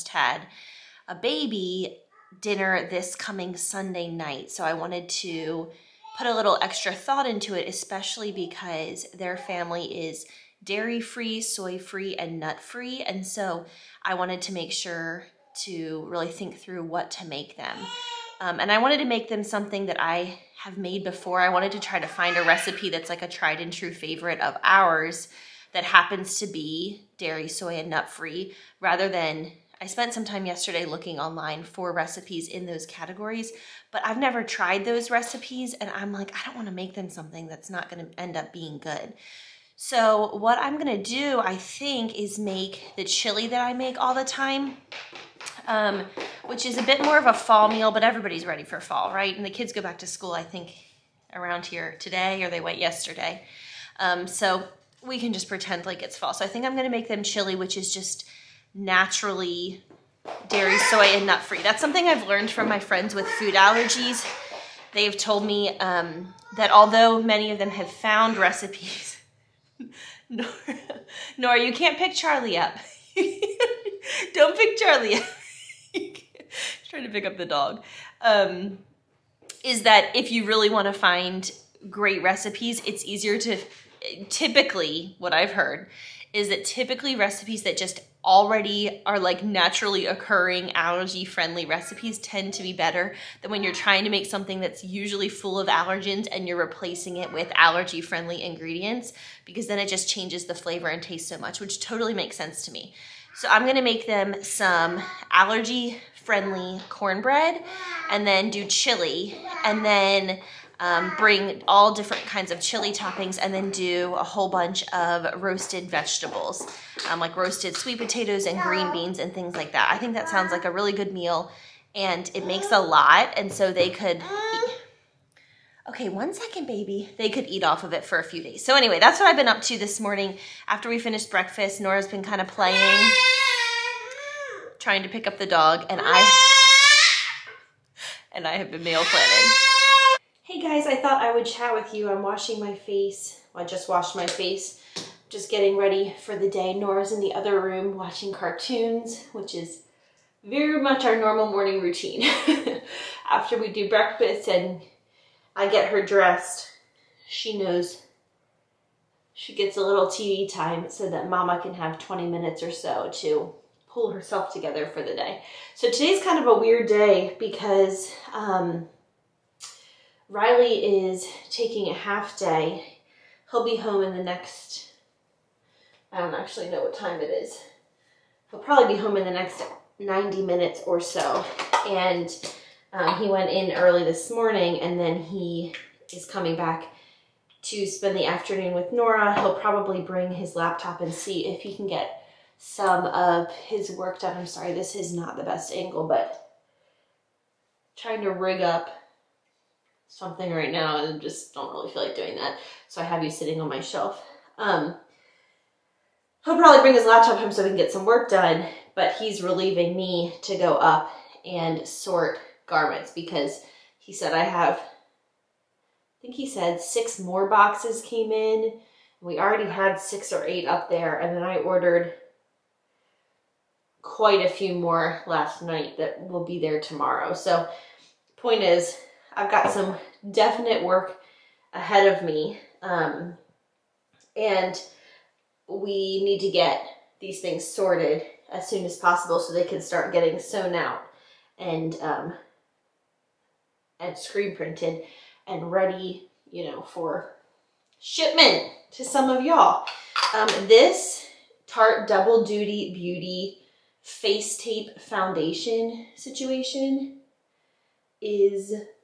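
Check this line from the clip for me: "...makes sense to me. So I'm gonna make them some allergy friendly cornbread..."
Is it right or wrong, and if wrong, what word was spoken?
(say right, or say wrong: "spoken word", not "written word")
right.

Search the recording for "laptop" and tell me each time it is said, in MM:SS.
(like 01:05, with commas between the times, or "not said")
03:10, 03:27.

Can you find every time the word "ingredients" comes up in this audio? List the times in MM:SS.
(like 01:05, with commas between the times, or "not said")
01:38.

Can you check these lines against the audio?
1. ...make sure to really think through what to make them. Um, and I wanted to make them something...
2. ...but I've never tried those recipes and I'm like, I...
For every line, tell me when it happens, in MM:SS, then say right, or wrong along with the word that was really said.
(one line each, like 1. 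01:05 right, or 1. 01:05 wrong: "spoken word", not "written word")
1. 00:14 right
2. 00:33 right.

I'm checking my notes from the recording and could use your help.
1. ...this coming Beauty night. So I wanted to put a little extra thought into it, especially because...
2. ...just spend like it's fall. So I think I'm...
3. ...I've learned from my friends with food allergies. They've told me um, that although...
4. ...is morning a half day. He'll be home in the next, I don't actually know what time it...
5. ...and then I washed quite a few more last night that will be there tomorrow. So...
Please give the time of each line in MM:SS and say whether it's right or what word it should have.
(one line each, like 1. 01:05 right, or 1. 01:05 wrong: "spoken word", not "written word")
1. 00:02 wrong: "Sunday", not "Beauty"
2. 00:55 wrong: "pretend", not "spend"
3. 01:02 right
4. 02:51 wrong: "taking", not "morning"
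5. 03:41 wrong: "ordered", not "washed".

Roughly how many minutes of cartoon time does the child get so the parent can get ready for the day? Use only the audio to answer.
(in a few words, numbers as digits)
20.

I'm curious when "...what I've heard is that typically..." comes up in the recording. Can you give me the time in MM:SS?
01:25.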